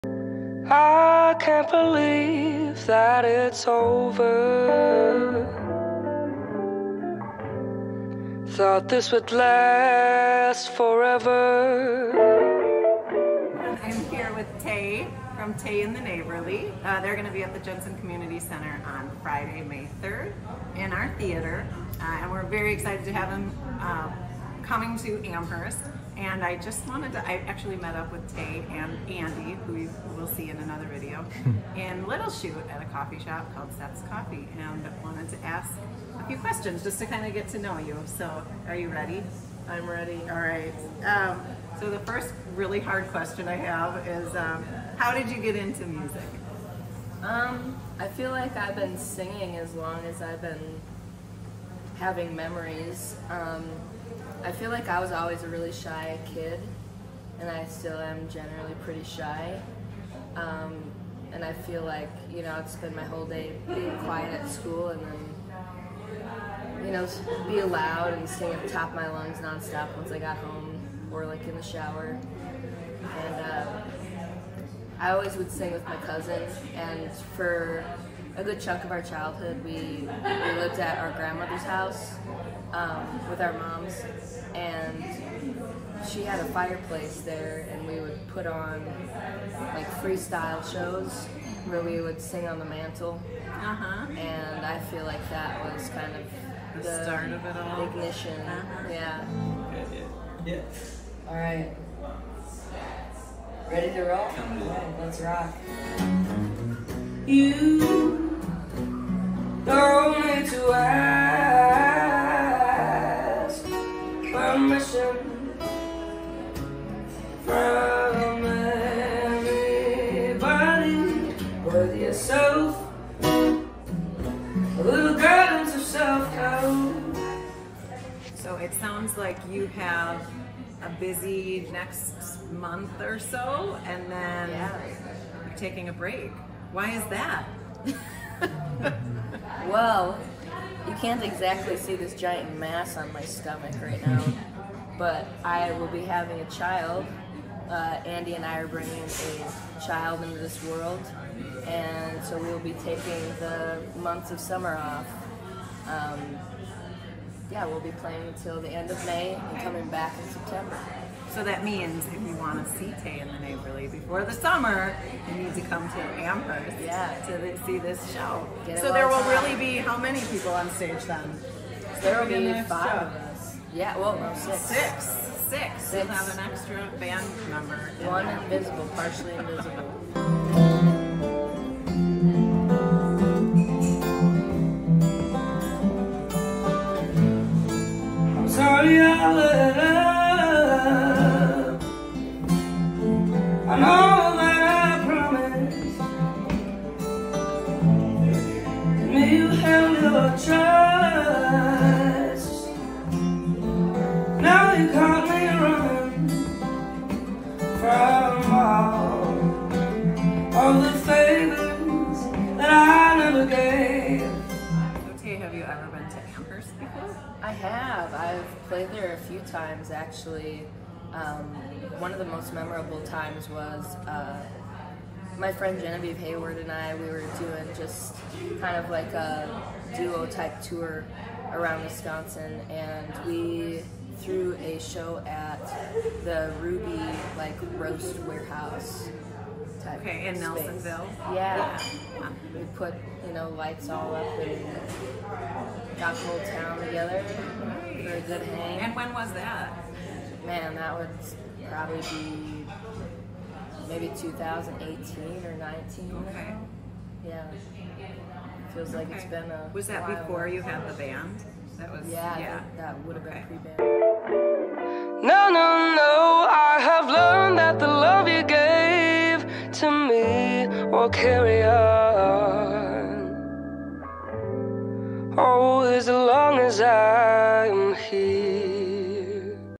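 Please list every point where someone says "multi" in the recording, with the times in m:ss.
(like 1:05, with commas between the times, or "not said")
not said.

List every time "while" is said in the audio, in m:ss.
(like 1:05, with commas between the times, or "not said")
4:20.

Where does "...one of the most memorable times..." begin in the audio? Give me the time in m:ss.
3:41.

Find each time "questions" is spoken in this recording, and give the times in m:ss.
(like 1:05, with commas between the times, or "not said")
0:36, 0:43.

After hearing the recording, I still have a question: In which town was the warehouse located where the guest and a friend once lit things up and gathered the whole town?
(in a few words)
Nelsonville.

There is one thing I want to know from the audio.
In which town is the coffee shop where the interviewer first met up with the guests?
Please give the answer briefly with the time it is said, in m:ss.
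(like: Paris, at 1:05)
Little Chute, at 0:32.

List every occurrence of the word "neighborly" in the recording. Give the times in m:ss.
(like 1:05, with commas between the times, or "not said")
0:15, 2:43.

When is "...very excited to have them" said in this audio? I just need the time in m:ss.
0:22.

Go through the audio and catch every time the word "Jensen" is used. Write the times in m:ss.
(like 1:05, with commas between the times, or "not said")
0:17.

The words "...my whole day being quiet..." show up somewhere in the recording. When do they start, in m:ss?
1:02.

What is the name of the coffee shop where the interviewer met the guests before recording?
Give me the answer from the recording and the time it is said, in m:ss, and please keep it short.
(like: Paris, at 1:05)
Seth's Coffee, at 0:33.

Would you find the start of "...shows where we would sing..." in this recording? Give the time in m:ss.
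1:30.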